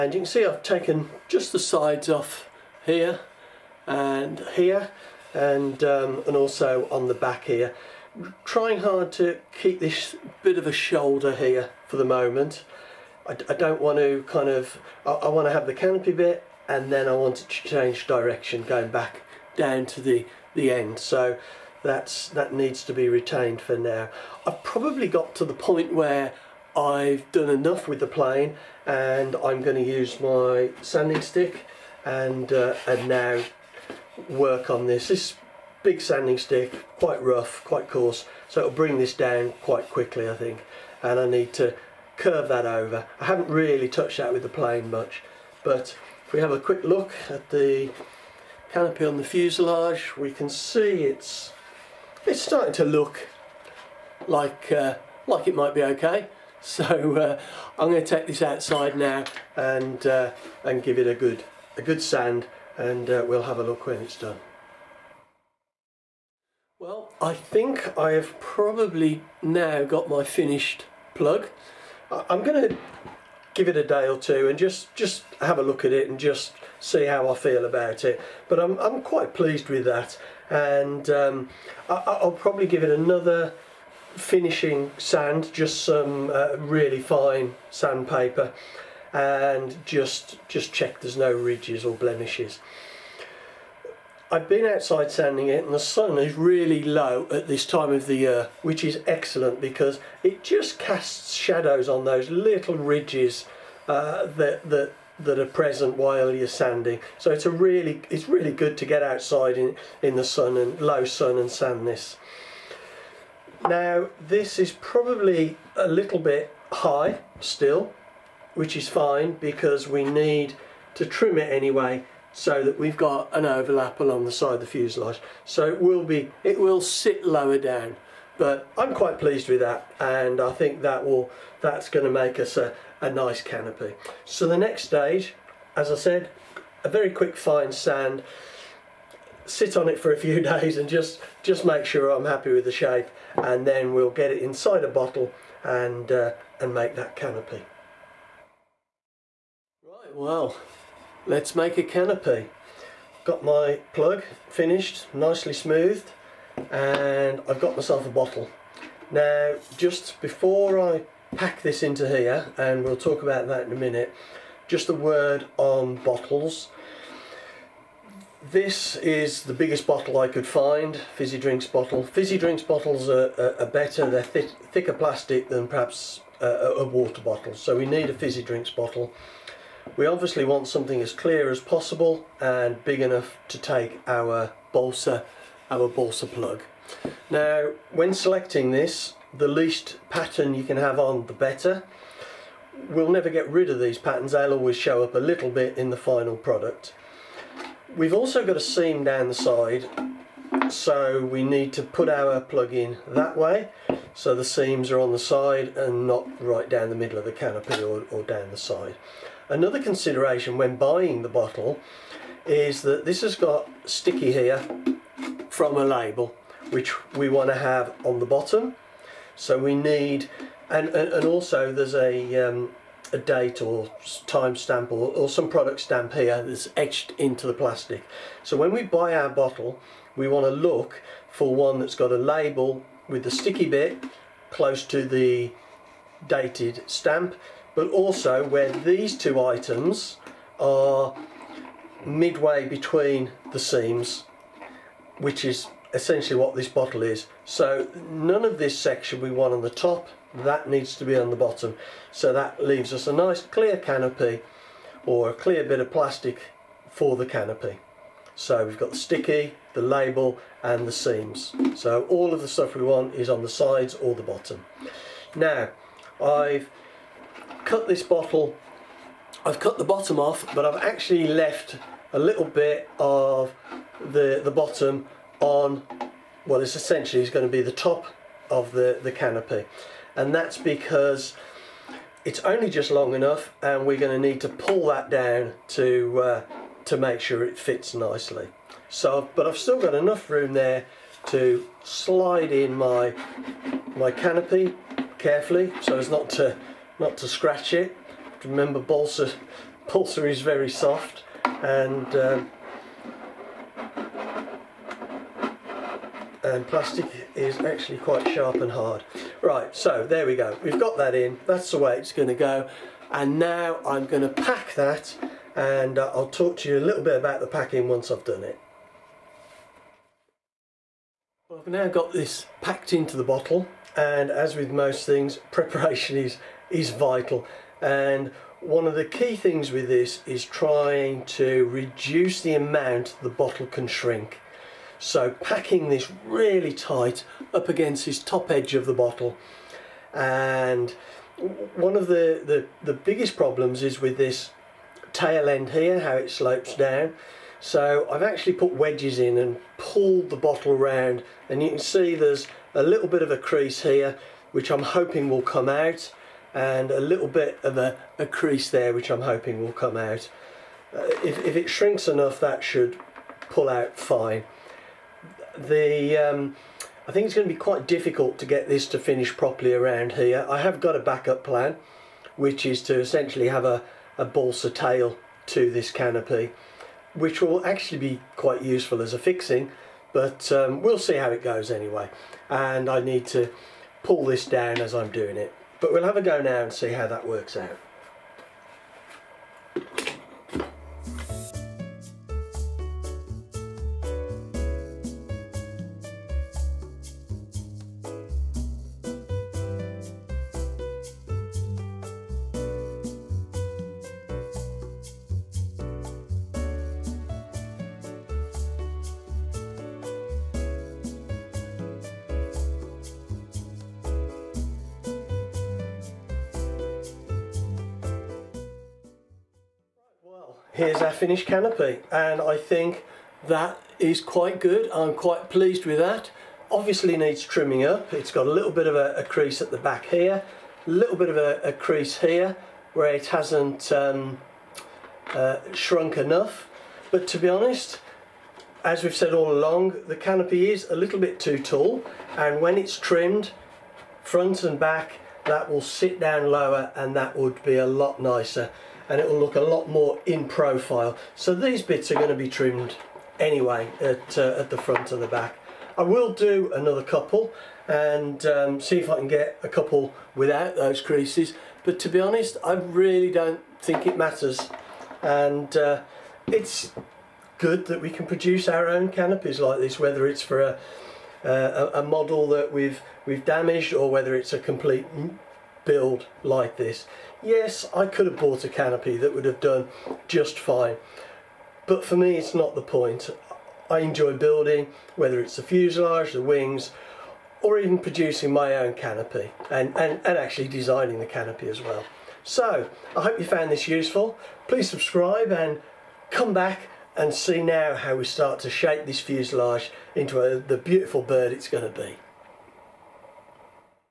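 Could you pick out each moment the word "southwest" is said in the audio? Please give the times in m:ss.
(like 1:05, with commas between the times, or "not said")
not said.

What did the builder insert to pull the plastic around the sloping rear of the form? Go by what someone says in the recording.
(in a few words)
wedges.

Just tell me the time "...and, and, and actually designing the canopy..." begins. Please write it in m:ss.
8:09.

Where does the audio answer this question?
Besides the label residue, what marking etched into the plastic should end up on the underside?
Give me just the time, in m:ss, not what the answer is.
3:43.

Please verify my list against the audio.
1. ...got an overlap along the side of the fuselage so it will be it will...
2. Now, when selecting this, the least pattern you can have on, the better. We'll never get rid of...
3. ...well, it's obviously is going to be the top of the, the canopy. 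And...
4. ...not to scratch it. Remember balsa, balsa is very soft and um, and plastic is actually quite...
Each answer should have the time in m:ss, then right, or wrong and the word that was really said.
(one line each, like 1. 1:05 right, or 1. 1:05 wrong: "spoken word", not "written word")
1. 2:02 right
2. 3:07 right
3. 4:36 wrong: "essentially", not "obviously"
4. 4:56 right.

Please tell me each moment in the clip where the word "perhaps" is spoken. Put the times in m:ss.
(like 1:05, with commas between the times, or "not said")
2:55.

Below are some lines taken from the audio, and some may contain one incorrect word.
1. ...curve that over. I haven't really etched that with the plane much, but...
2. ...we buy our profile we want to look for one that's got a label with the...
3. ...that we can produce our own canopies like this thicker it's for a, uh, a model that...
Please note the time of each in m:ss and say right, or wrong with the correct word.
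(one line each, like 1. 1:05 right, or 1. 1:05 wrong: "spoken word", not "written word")
1. 0:42 wrong: "touched", not "etched"
2. 3:48 wrong: "bottle", not "profile"
3. 7:47 wrong: "whether", not "thicker".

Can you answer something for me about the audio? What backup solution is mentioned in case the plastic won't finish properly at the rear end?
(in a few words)
a balsa tail.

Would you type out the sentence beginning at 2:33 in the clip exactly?
Got my plug finished, nicely smoothed, and I've got myself a bottle.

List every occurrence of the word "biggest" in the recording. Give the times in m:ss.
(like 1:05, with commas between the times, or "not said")
2:49, 5:42.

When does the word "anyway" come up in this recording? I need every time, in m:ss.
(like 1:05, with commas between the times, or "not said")
2:01, 6:21, 7:33.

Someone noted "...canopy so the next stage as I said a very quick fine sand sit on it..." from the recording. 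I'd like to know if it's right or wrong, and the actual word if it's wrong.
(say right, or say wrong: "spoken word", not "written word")
right.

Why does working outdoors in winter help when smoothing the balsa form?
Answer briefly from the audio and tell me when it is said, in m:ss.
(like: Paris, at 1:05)
low sun, at 1:50.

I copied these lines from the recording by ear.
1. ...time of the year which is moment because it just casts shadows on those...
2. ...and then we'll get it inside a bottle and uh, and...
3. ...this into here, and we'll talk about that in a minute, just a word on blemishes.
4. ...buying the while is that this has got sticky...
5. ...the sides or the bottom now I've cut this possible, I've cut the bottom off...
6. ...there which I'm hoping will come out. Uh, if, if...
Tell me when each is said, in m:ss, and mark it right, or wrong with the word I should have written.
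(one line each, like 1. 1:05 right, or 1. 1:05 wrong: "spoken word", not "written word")
1. 1:37 wrong: "excellent", not "moment"
2. 2:23 right
3. 2:41 wrong: "bottles", not "blemishes"
4. 3:30 wrong: "bottle", not "while"
5. 4:23 wrong: "bottle", not "possible"
6. 5:58 right.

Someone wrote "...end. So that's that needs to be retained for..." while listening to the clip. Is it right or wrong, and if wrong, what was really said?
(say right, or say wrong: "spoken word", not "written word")
right.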